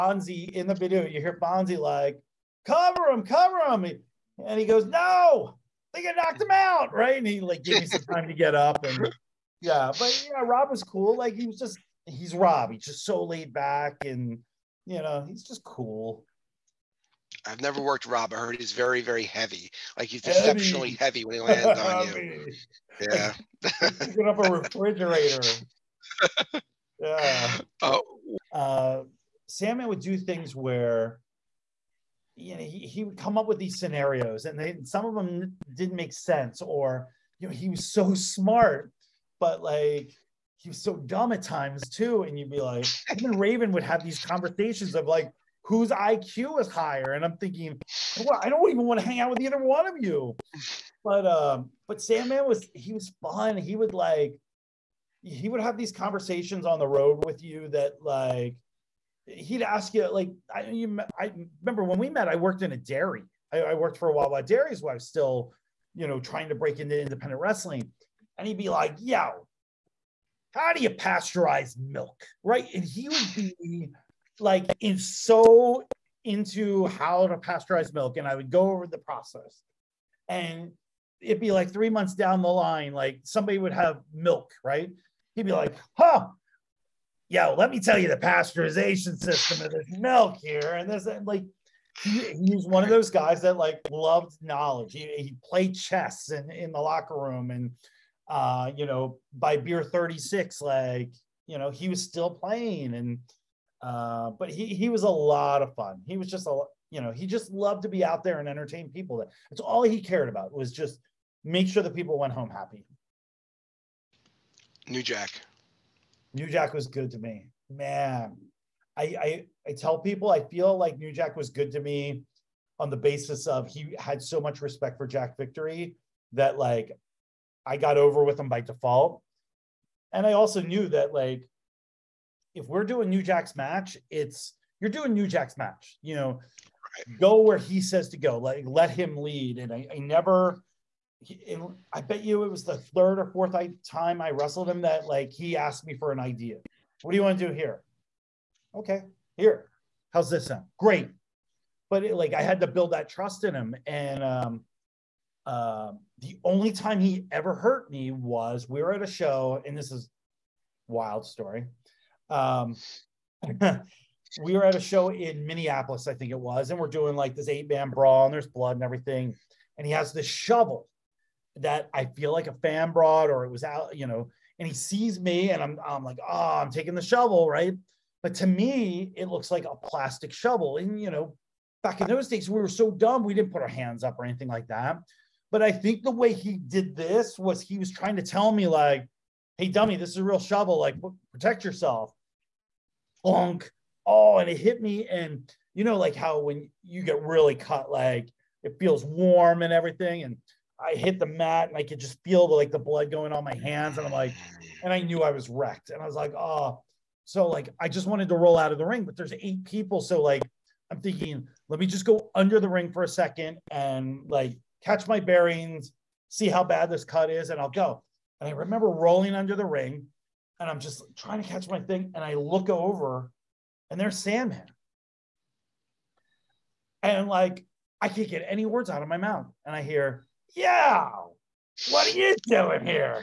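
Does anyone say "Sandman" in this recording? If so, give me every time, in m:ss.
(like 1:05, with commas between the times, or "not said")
0:29, 0:51.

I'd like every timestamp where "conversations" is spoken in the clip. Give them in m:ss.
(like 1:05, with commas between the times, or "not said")
0:44, 0:55.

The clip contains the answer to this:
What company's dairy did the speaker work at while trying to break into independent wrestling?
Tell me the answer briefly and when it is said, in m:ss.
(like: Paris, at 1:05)
Wawa Dairies, at 1:04.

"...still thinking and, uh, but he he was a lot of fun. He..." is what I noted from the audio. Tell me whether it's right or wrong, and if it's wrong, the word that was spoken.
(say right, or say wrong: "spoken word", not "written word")
wrong: "playing", not "thinking".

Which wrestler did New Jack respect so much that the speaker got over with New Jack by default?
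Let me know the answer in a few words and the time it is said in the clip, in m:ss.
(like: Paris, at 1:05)
Jack Victory, at 2:05.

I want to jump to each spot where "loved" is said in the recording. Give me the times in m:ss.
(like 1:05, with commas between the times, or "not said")
1:33, 1:47.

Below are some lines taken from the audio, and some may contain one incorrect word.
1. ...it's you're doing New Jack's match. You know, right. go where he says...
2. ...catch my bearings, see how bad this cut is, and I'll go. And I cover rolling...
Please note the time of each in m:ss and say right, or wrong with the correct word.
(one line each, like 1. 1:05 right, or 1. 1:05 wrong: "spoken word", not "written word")
1. 2:14 right
2. 3:34 wrong: "remember", not "cover".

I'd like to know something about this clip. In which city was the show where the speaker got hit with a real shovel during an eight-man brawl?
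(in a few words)
Minneapolis.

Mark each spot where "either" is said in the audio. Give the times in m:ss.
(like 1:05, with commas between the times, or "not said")
0:49.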